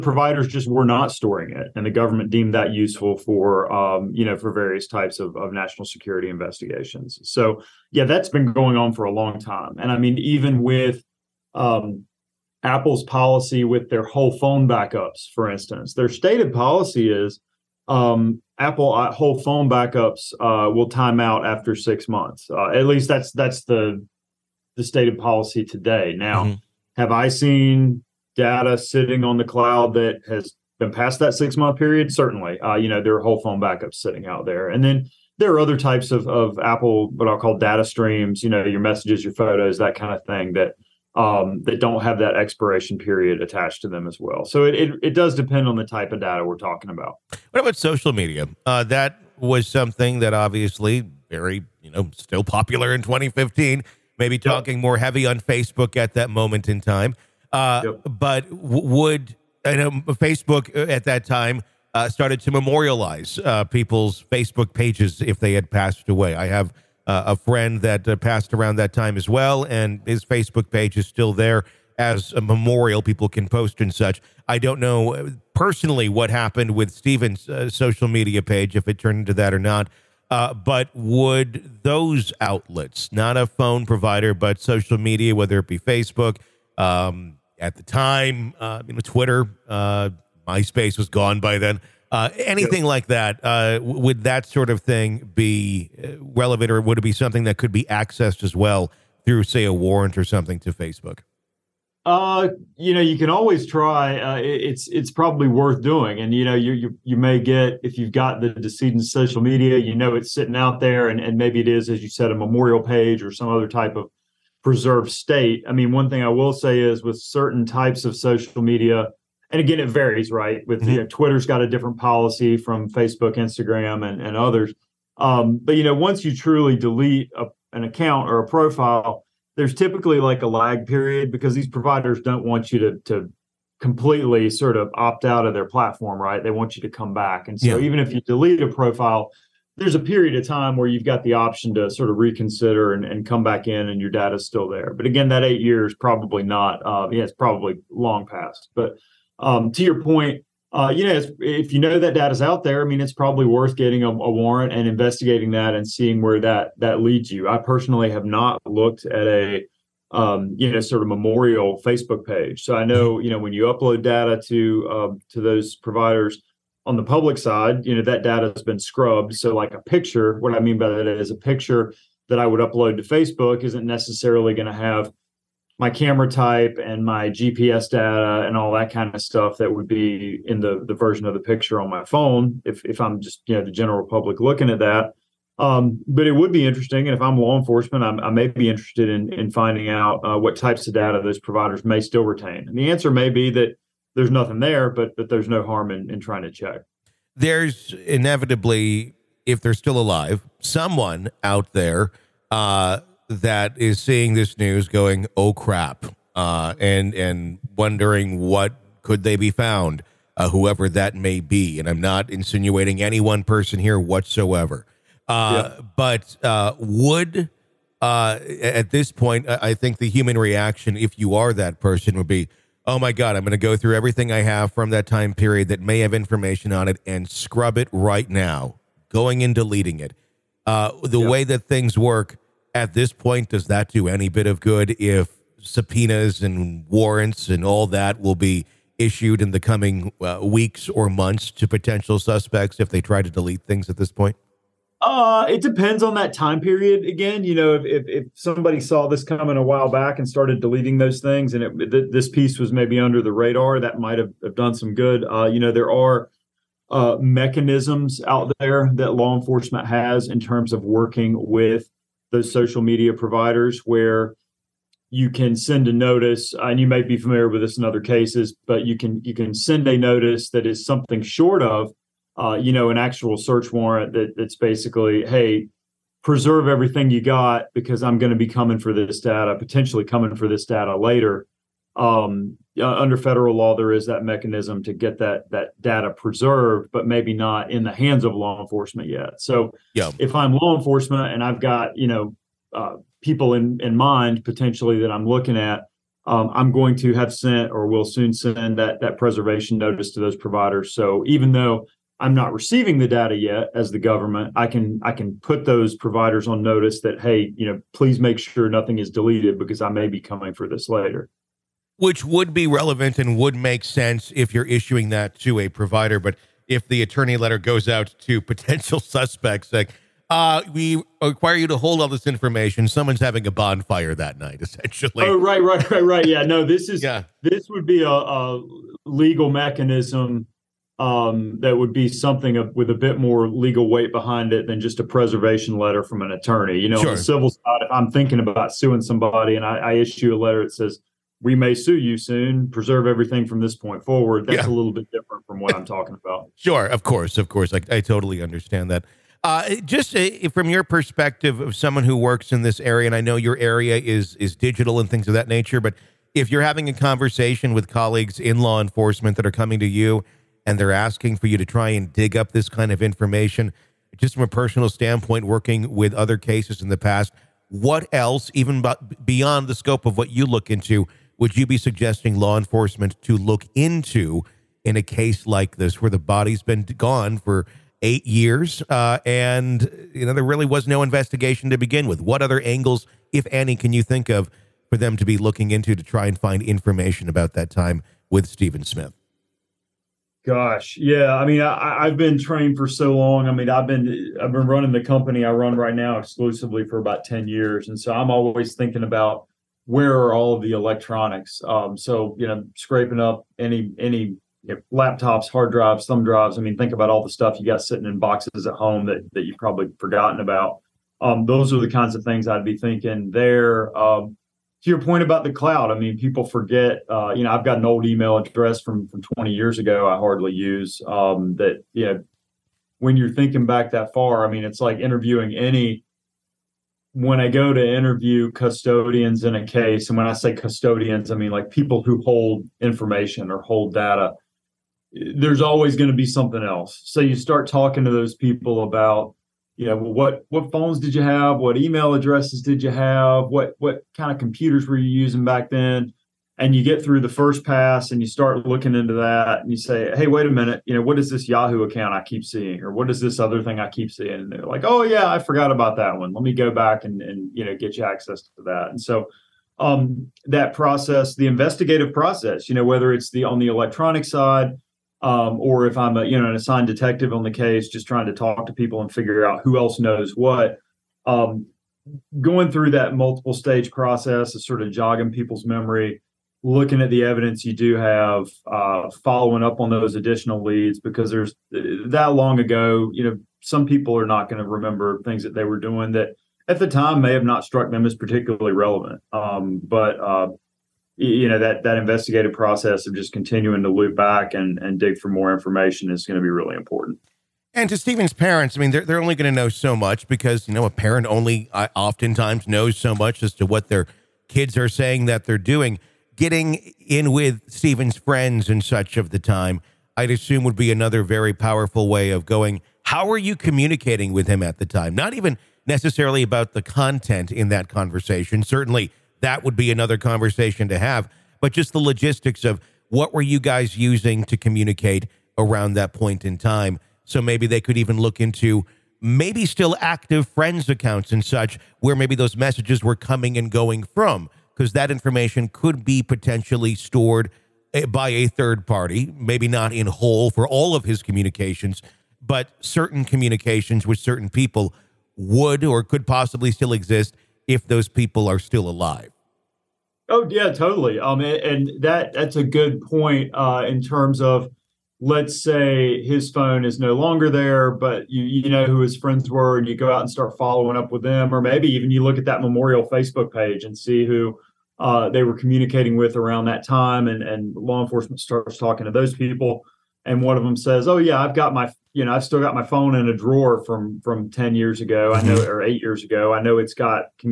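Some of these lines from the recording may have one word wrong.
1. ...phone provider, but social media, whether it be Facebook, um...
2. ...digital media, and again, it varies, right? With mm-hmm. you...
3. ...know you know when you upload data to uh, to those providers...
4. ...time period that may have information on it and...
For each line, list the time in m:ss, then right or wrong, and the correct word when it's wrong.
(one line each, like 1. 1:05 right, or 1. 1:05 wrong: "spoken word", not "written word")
1. 1:23 right
2. 1:58 wrong: "social", not "digital"
3. 2:42 right
4. 3:45 right.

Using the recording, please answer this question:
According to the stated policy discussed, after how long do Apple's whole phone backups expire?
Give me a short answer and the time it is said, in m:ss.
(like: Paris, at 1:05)
6 months, at 0:21.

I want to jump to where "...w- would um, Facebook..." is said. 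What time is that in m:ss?
0:58.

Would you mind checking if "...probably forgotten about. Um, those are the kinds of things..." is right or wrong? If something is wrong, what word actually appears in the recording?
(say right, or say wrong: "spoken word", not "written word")
right.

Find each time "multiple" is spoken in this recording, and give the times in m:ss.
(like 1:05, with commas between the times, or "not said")
7:53.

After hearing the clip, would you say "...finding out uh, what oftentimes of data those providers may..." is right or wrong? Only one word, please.
wrong.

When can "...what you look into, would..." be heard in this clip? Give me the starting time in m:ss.
6:10.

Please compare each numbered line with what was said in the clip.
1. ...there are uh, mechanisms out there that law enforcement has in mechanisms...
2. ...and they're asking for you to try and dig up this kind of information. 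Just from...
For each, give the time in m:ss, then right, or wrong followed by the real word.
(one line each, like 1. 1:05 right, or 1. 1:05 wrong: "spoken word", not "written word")
1. 4:15 wrong: "terms", not "mechanisms"
2. 6:00 right.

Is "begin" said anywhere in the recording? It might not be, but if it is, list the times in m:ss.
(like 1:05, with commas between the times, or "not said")
6:21.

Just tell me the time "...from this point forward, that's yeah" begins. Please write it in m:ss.
5:43.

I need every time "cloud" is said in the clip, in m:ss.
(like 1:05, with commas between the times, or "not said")
0:29, 6:55.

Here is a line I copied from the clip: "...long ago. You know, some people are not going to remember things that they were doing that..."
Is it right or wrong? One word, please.
right.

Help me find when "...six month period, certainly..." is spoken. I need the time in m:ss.
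0:31.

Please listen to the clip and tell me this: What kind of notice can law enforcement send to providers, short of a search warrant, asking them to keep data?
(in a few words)
Preservation notice.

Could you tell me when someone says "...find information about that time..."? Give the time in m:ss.
6:26.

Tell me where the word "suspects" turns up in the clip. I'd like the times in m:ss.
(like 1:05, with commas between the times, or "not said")
4:02, 5:18.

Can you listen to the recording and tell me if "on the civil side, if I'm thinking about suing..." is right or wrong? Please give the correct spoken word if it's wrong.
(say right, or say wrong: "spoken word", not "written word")
right.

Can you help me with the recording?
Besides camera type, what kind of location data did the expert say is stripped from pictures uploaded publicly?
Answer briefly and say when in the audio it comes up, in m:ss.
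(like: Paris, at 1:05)
GPS data, at 2:57.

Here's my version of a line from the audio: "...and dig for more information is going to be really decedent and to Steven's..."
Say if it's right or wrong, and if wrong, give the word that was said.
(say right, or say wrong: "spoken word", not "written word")
wrong: "important", not "decedent".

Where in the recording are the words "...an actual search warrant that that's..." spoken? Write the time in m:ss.
4:32.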